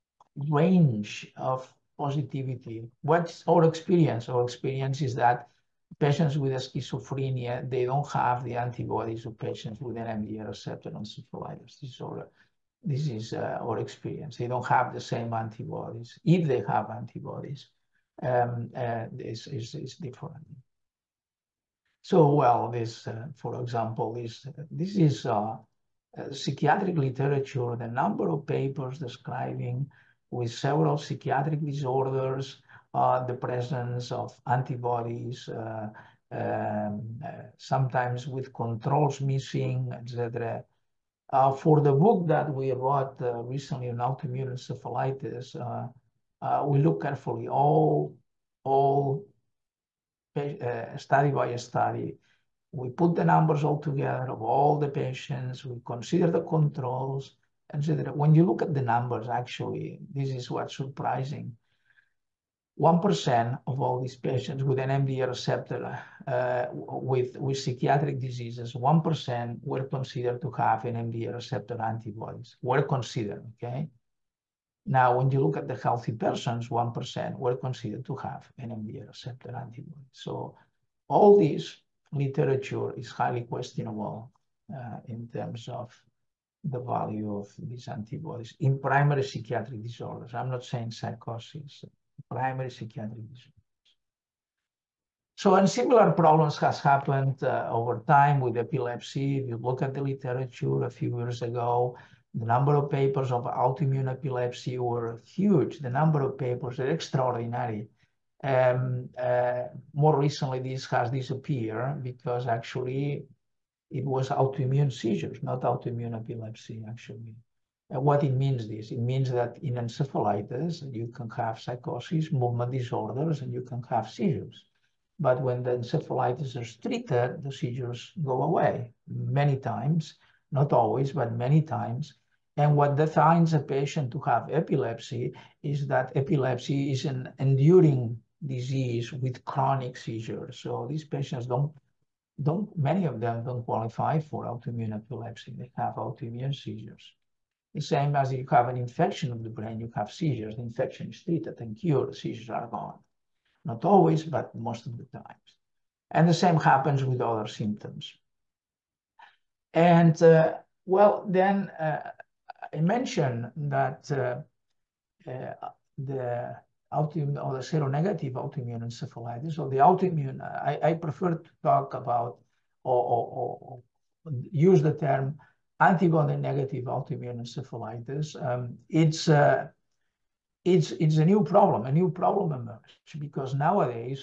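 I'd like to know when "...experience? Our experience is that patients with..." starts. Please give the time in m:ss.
0:03.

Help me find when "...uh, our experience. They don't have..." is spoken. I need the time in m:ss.
0:13.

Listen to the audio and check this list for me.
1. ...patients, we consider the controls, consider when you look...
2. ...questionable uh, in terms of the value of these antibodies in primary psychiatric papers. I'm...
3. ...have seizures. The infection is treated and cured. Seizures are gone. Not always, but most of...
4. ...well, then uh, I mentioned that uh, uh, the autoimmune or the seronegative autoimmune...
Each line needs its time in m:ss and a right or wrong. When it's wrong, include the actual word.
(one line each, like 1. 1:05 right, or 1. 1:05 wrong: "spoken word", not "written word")
1. 0:54 right
2. 1:23 wrong: "disorders", not "papers"
3. 2:29 right
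4. 2:40 right.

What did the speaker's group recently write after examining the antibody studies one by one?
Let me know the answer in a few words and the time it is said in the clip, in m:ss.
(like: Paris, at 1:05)
book, at 0:41.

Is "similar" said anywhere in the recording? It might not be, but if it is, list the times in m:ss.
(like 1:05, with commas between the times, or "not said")
1:35.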